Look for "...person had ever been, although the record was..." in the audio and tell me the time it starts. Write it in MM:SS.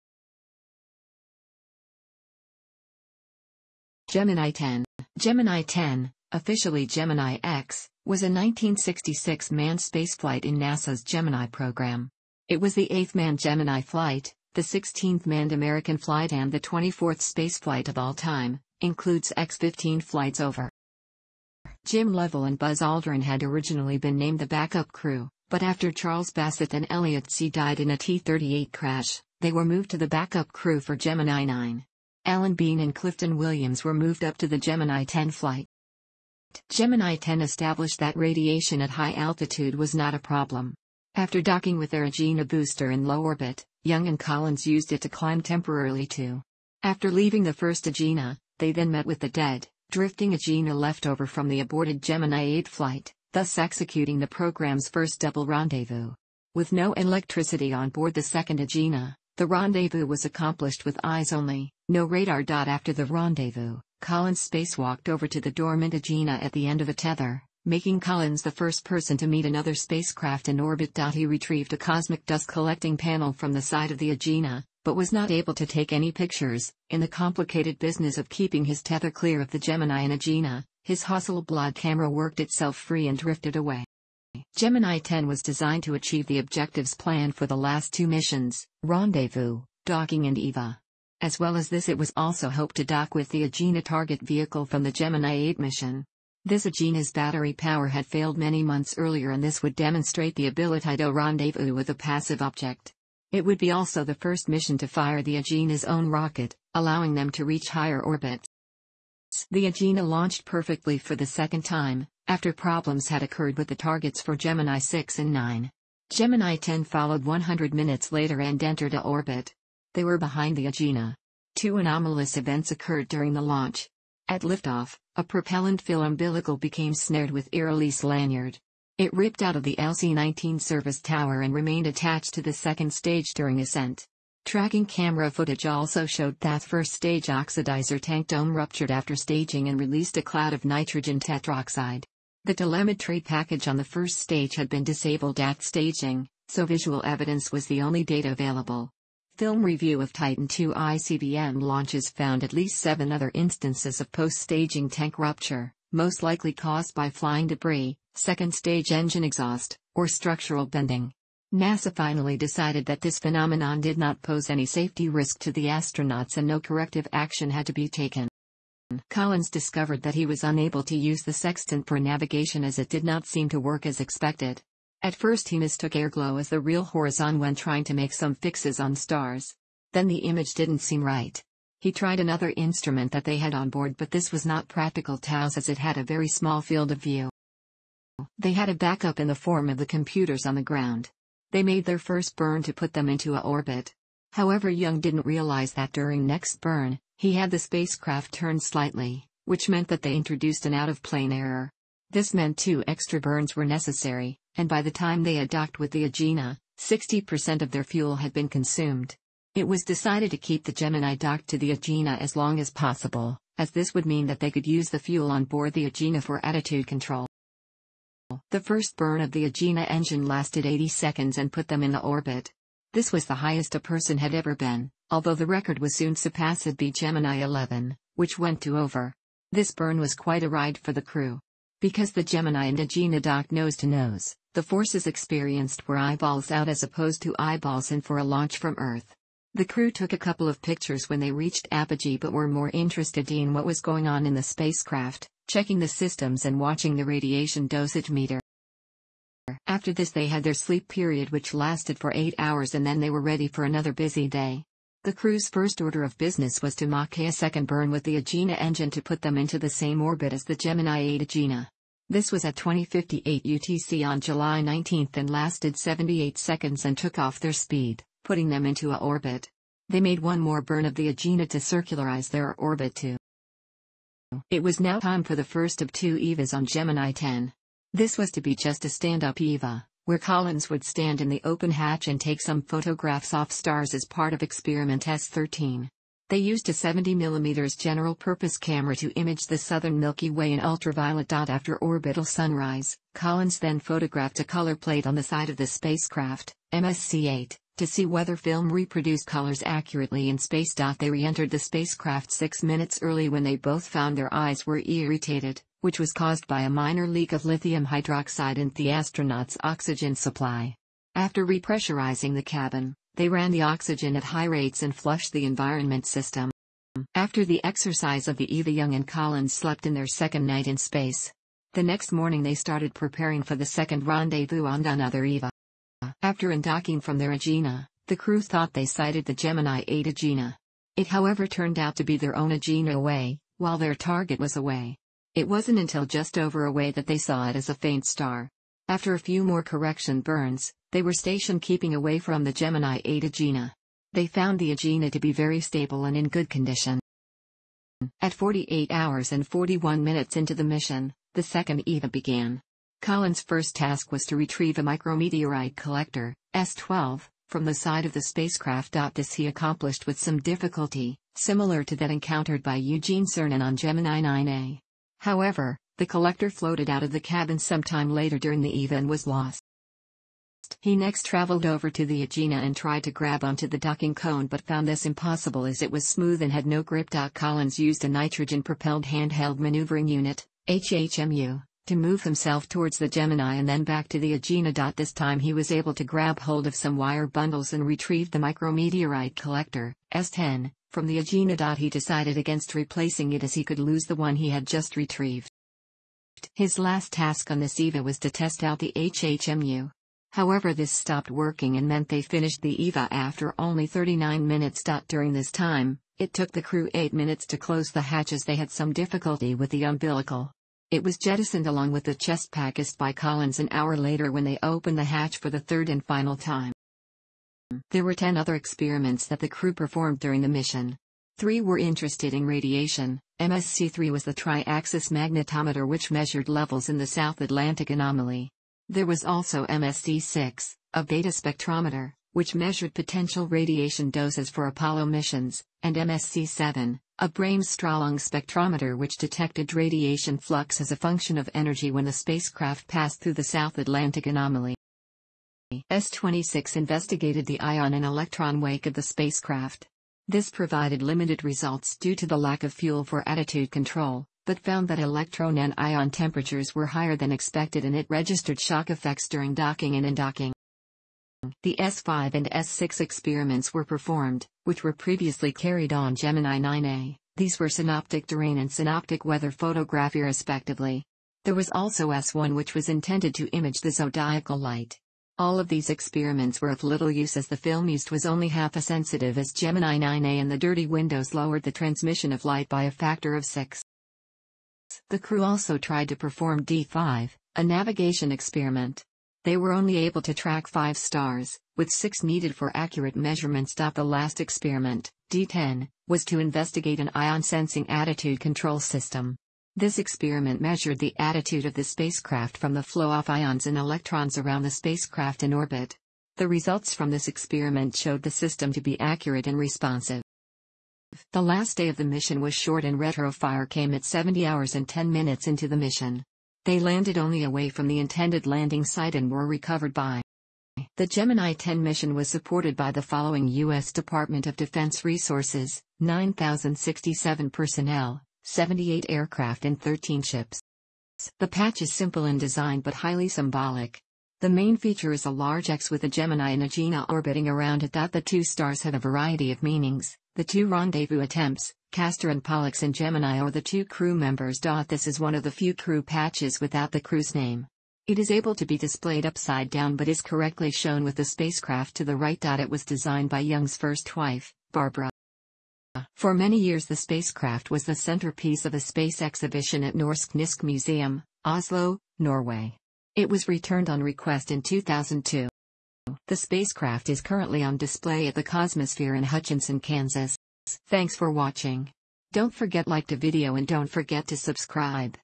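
03:43.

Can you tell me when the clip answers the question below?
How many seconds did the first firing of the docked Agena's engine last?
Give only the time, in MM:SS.
03:40.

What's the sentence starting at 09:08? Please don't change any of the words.
It is able to be displayed upside down but is correctly shown with the spacecraft to the right.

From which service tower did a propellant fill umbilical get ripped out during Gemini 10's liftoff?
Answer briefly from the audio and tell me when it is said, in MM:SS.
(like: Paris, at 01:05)
LC-19, at 02:09.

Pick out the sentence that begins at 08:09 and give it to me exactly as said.
They were only able to track 5 stars, with 6 needed for accurate measurements.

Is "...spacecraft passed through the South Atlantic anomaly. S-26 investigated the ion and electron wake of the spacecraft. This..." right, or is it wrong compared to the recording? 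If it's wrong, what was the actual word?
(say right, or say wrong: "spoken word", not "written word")
right.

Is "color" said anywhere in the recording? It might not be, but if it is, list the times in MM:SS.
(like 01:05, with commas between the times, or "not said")
04:54, 04:59.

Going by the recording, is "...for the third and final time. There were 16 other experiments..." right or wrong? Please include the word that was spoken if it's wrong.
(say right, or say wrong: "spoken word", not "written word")
wrong: "10", not "16".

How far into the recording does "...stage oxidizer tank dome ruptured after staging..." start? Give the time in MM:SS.
02:16.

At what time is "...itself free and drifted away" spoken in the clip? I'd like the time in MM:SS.
01:22.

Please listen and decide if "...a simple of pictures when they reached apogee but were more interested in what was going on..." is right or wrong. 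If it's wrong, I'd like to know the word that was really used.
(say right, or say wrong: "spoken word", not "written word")
wrong: "couple", not "simple".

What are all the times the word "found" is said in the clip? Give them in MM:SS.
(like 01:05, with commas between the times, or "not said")
02:32, 05:03, 05:44, 06:14, 07:34.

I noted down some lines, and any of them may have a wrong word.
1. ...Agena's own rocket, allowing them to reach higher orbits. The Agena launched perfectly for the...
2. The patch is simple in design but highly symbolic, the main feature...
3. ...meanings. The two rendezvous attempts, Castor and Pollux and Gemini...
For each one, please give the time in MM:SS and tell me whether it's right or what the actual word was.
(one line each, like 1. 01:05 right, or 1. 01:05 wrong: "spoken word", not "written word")
1. 01:45 right
2. 08:51 right
3. 08:59 right.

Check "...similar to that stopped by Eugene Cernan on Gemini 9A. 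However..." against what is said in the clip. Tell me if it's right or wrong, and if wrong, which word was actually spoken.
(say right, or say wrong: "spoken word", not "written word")
wrong: "encountered", not "stopped".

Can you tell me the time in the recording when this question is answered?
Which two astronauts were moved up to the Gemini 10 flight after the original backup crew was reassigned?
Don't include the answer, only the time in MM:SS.
00:32.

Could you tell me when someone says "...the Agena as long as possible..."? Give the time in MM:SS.
03:31.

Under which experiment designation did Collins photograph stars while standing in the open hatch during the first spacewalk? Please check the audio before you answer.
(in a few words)
S-13.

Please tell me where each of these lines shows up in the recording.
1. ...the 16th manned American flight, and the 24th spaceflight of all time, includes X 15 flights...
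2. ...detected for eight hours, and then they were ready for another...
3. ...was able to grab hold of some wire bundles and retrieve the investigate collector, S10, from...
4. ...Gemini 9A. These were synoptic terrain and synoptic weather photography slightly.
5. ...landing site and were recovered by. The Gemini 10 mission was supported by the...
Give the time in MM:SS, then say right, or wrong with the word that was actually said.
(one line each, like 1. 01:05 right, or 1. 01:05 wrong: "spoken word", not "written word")
1. 00:14 right
2. 04:11 wrong: "lasted", not "detected"
3. 06:25 wrong: "micrometeorite", not "investigate"
4. 07:46 wrong: "respectively", not "slightly"
5. 08:38 right.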